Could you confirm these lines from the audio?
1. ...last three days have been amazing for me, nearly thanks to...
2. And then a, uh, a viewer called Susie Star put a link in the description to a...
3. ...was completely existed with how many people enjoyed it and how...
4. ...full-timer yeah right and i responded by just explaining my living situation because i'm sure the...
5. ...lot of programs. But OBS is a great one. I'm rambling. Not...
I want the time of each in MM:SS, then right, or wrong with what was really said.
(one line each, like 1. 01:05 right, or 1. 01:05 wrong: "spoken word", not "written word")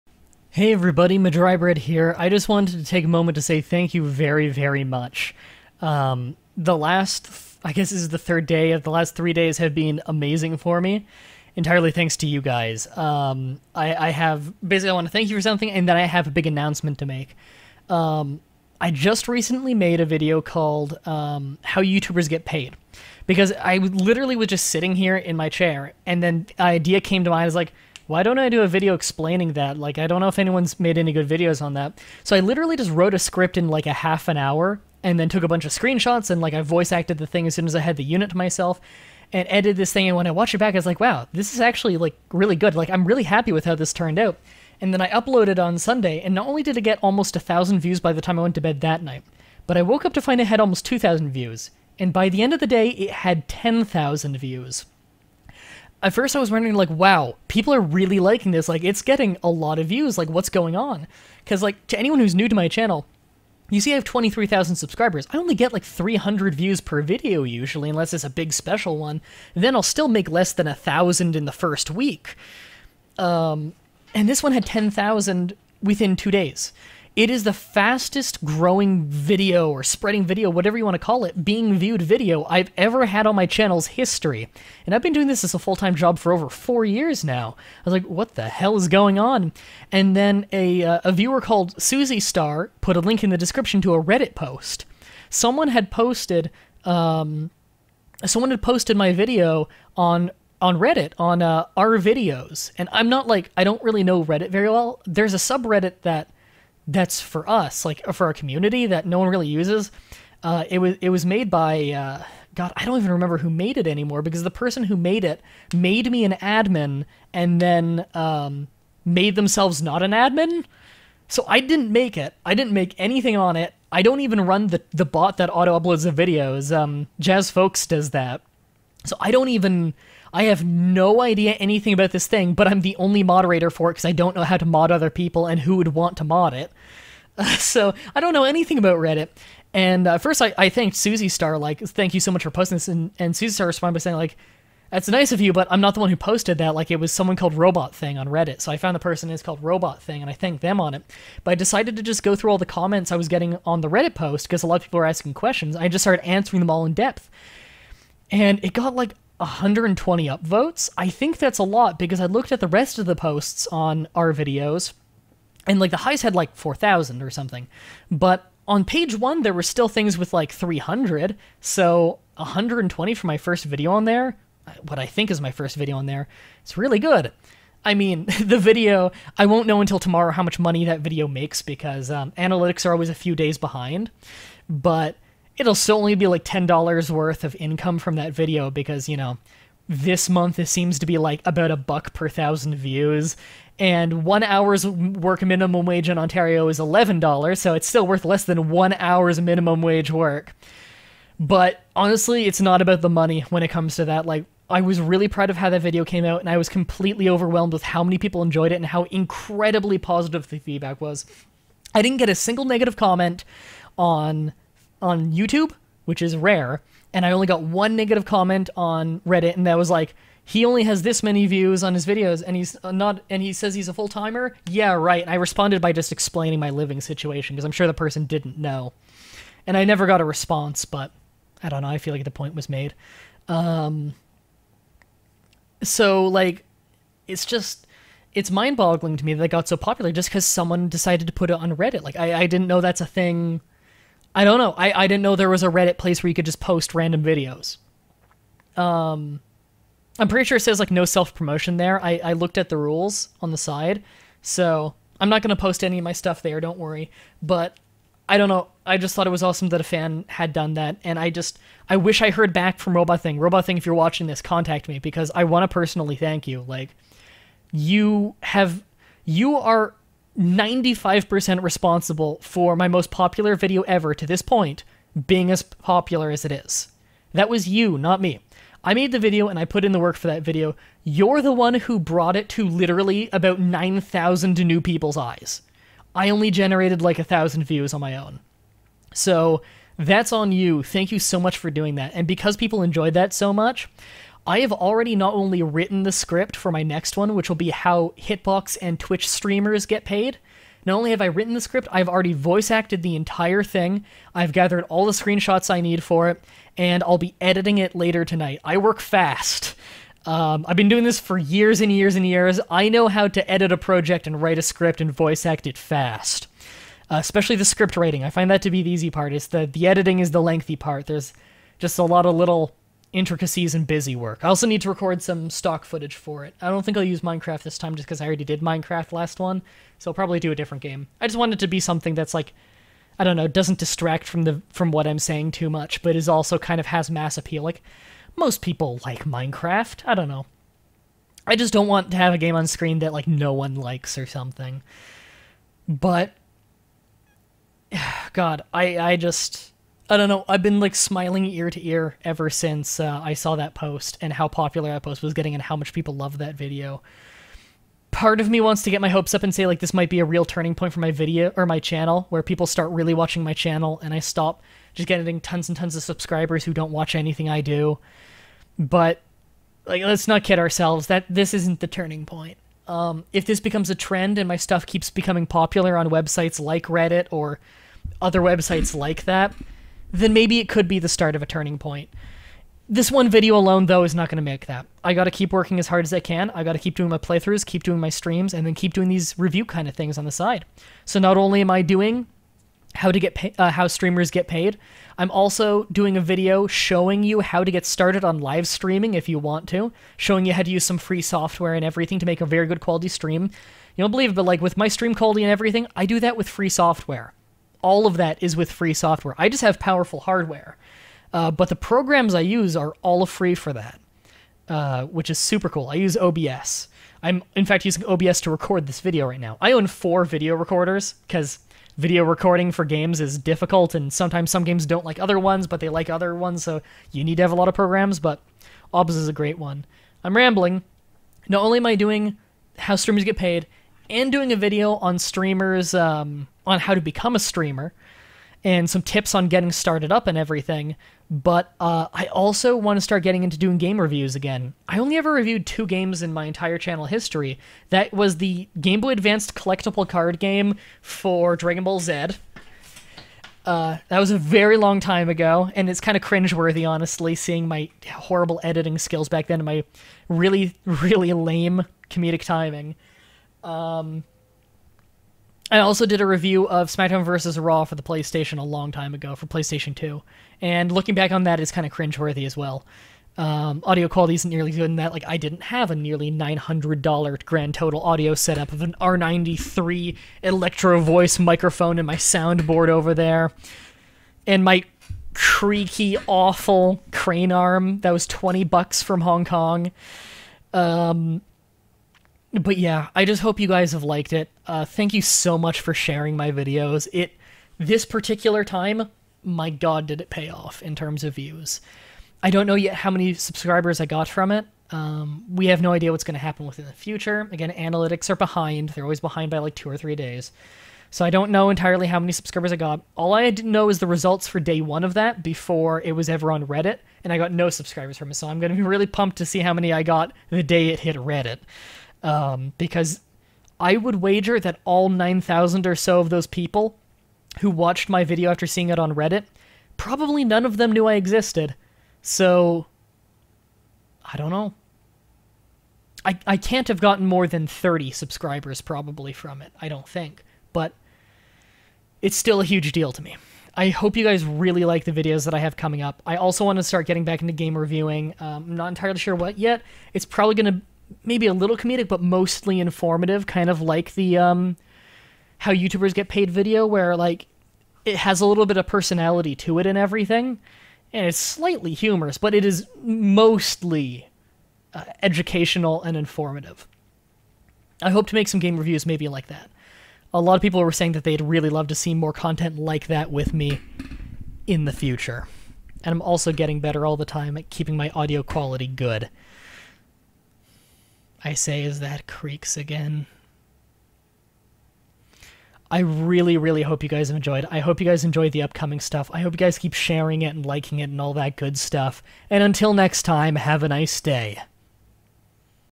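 1. 00:08 wrong: "entirely", not "nearly"
2. 01:29 right
3. 03:26 wrong: "overwhelmed", not "existed"
4. 03:43 right
5. 07:07 right.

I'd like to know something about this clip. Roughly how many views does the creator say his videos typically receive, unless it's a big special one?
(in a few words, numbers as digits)
300.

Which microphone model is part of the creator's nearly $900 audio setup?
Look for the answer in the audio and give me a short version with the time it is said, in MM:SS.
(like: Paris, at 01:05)
R93 Electro Voice, at 07:58.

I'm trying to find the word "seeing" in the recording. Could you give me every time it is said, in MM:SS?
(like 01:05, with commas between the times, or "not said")
07:37, 08:48.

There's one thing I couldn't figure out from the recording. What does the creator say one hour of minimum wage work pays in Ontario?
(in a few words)
$11.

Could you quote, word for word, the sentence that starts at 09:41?
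I say is that creaks again.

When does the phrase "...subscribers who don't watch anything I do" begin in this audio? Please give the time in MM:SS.
06:06.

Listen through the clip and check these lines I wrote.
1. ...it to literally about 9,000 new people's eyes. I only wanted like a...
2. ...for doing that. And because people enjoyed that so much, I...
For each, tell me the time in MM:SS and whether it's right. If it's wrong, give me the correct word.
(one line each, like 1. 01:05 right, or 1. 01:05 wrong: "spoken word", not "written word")
1. 04:42 wrong: "generated", not "wanted"
2. 04:51 right.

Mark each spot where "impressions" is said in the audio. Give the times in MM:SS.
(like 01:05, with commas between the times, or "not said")
not said.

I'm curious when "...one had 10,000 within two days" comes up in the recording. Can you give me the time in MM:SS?
01:14.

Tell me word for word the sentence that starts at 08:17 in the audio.
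It this particular time, my god, did it pay off in terms of views.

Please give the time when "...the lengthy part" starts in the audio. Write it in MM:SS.
05:20.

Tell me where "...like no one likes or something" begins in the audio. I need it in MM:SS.
05:43.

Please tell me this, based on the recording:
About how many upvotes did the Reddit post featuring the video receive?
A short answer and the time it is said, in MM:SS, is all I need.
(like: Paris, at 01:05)
120, at 02:39.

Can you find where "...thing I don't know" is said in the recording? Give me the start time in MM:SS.
04:03.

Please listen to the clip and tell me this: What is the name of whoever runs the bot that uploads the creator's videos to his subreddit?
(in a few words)
Jazz Folks.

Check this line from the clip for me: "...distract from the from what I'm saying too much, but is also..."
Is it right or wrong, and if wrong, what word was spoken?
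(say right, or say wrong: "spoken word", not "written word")
right.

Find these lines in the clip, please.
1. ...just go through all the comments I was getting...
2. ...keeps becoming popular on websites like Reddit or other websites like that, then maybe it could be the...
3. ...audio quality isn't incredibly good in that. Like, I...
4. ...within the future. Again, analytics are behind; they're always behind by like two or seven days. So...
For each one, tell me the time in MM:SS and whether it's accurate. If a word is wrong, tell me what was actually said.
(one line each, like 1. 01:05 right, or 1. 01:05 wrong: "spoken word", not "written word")
1. 02:32 right
2. 06:14 right
3. 07:53 wrong: "nearly", not "incredibly"
4. 08:26 wrong: "three", not "seven".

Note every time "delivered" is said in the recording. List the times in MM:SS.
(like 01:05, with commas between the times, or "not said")
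not said.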